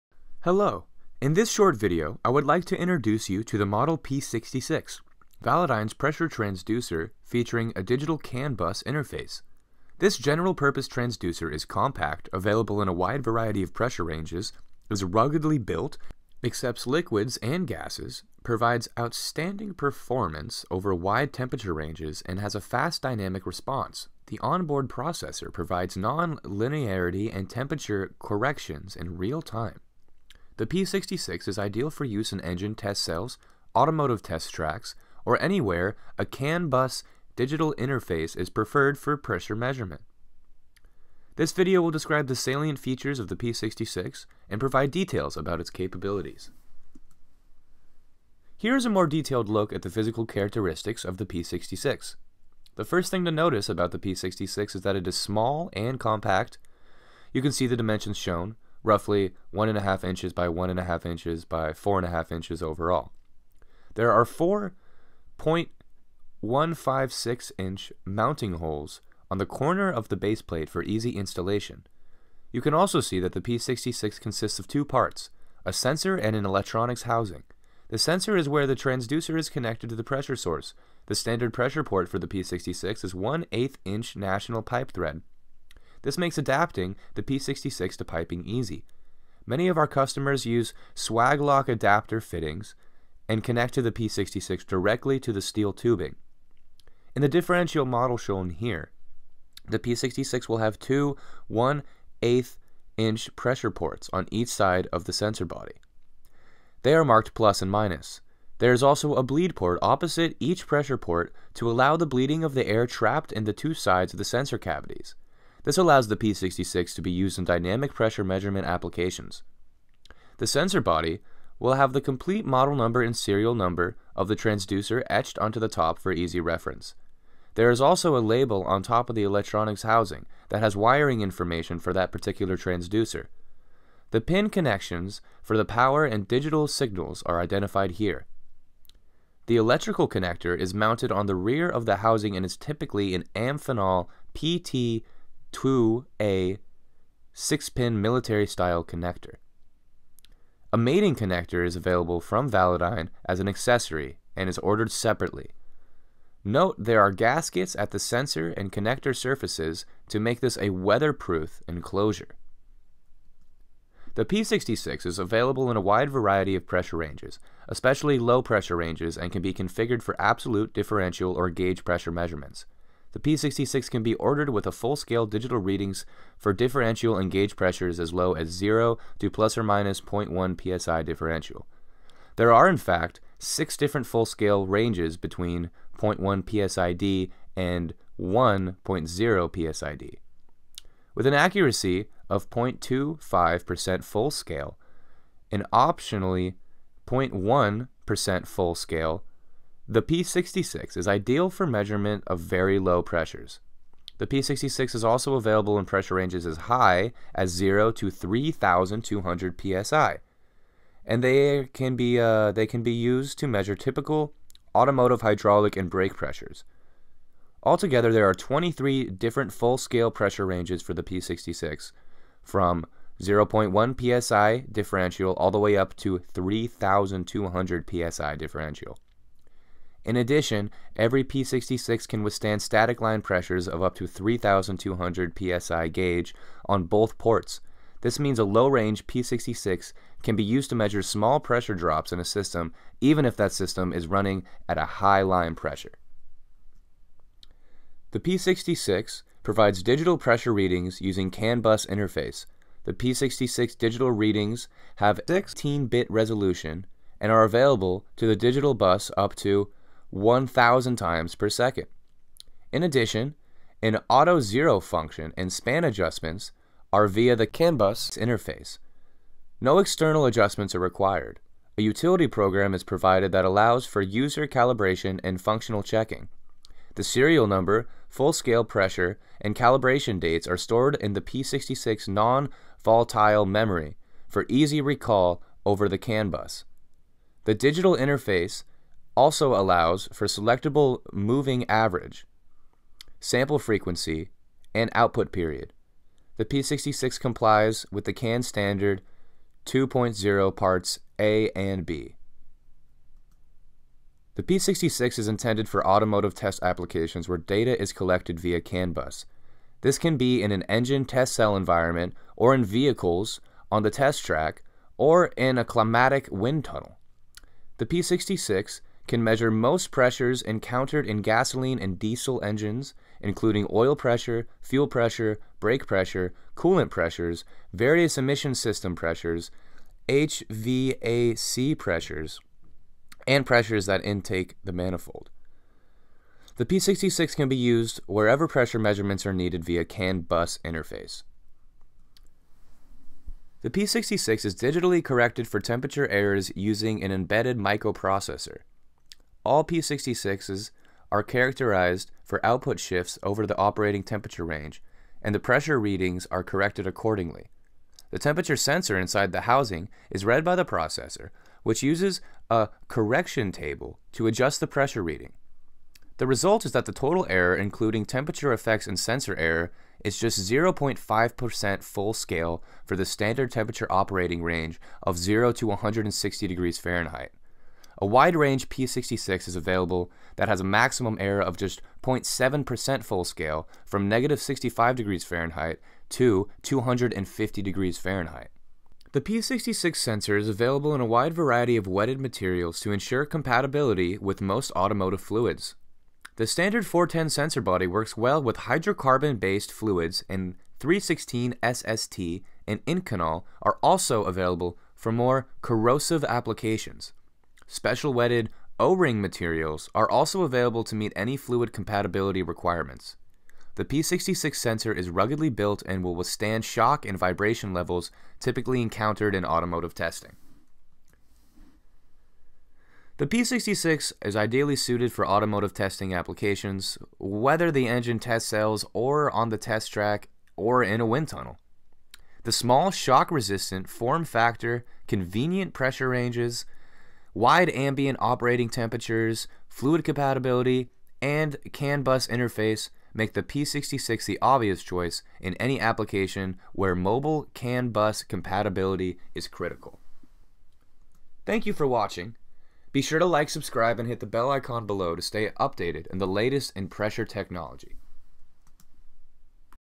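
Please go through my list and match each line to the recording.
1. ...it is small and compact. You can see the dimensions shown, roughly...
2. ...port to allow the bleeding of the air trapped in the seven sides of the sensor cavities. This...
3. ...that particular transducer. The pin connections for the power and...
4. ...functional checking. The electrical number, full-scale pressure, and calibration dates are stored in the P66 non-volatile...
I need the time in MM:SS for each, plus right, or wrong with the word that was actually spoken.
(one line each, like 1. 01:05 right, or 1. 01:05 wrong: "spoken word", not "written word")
1. 00:54 right
2. 01:50 wrong: "two", not "seven"
3. 02:11 right
4. 04:35 wrong: "serial", not "electrical".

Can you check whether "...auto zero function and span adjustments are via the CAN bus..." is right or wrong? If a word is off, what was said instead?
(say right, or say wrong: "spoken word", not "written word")
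right.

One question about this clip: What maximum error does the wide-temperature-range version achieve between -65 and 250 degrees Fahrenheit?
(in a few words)
0.7% full scale.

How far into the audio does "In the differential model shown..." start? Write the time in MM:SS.
01:37.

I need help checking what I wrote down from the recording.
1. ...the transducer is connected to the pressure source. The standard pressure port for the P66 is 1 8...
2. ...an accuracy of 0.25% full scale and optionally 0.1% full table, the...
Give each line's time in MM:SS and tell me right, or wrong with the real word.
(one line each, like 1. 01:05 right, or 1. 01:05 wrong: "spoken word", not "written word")
1. 01:18 right
2. 03:11 wrong: "scale", not "table".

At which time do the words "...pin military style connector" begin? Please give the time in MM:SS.
02:27.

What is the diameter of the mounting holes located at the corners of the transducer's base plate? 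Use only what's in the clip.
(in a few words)
0.156 inch.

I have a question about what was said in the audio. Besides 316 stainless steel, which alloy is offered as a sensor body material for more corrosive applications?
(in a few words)
Inconel.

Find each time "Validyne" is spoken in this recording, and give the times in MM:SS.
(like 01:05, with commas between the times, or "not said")
00:05, 02:32.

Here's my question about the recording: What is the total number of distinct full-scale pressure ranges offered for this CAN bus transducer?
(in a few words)
23.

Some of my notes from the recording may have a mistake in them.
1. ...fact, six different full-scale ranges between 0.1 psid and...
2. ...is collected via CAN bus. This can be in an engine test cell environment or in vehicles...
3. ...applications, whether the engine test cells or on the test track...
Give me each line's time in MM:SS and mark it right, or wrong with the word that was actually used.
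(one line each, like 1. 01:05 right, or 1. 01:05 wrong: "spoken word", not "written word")
1. 03:02 right
2. 05:07 right
3. 07:06 right.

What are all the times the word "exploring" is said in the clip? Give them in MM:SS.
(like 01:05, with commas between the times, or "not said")
not said.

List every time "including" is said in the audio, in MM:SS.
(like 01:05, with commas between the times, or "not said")
05:23, 06:07.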